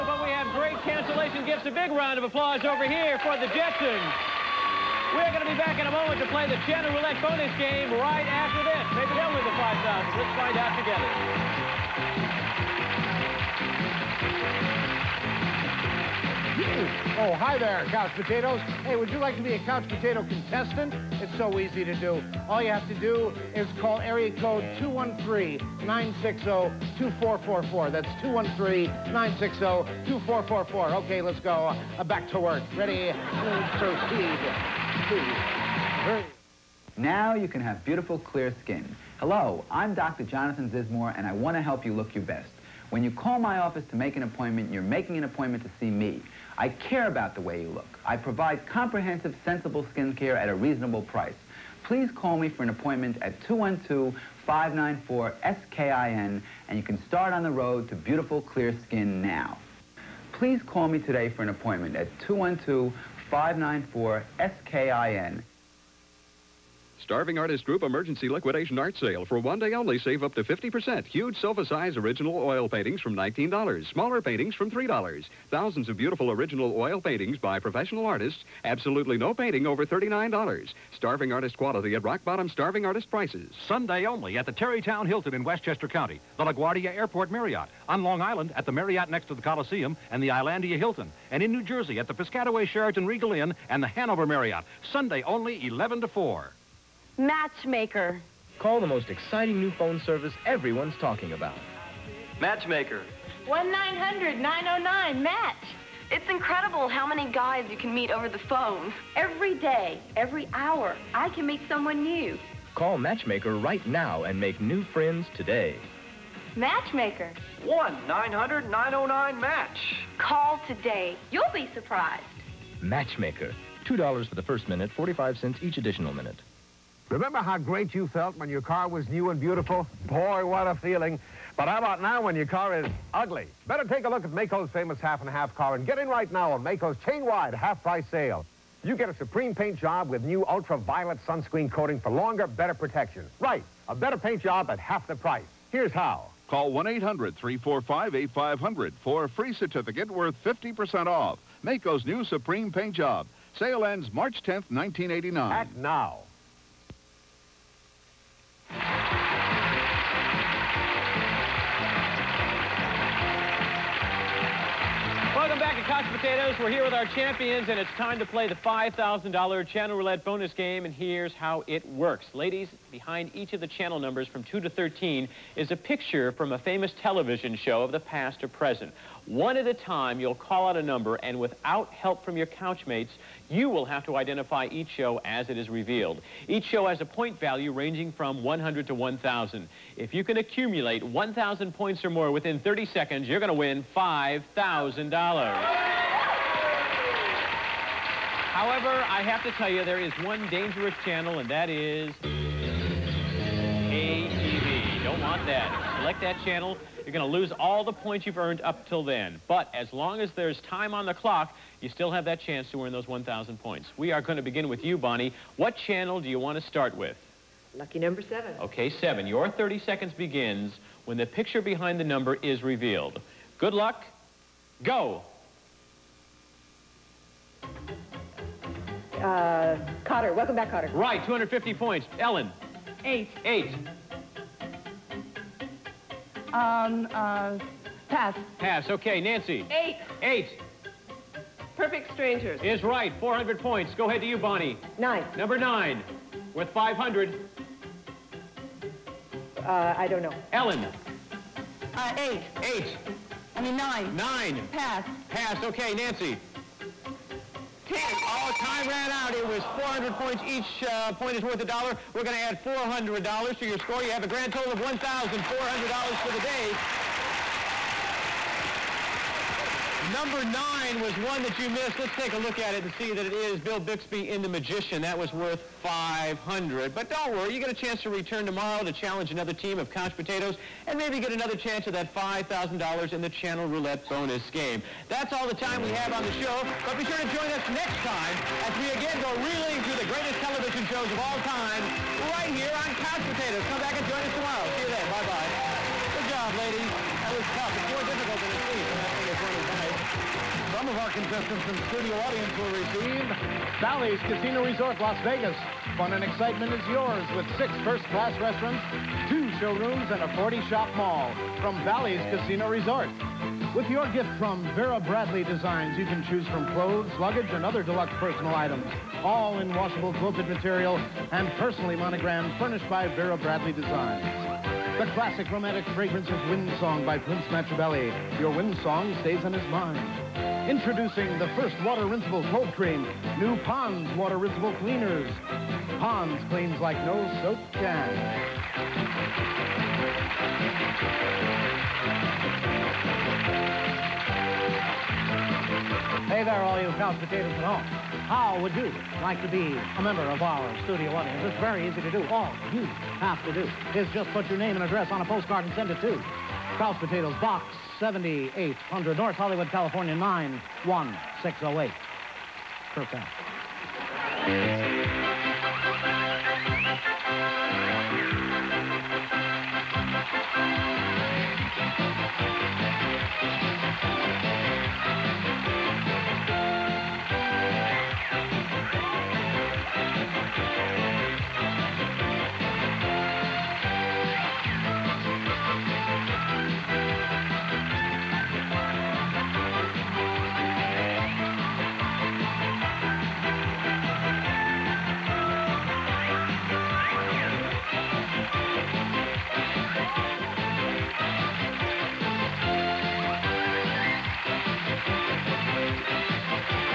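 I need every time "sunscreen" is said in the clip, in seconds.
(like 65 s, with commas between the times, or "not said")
141 s.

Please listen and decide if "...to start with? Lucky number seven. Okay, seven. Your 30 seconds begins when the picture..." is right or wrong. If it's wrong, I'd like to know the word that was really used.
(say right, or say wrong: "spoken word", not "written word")
right.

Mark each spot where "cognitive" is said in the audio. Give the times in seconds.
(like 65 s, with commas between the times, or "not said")
not said.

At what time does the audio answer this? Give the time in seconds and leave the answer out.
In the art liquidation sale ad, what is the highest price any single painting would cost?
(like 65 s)
79 s.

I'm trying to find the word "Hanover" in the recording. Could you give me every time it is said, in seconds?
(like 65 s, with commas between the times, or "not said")
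93 s.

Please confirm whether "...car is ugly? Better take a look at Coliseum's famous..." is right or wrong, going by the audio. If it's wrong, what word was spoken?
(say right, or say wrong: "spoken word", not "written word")
wrong: "Maaco", not "Coliseum".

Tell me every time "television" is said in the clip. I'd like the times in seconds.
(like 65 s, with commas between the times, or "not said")
177 s, 290 s.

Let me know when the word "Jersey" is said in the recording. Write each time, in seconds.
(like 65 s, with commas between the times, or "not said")
91 s.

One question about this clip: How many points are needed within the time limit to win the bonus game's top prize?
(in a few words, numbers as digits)
1,000.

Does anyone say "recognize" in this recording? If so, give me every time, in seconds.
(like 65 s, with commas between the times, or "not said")
not said.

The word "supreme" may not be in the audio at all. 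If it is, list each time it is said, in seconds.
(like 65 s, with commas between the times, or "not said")
139 s, 152 s.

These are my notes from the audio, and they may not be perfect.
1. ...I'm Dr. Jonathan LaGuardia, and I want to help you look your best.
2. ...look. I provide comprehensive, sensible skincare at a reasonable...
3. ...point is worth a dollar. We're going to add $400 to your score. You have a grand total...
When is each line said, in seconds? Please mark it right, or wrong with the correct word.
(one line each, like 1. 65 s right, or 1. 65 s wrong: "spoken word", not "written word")
1. 39 s wrong: "Zizmor", not "LaGuardia"
2. 47 s right
3. 261 s right.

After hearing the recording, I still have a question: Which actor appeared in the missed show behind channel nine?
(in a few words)
Bill Bixby.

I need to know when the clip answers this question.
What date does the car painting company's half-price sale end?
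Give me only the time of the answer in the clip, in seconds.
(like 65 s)
154 s.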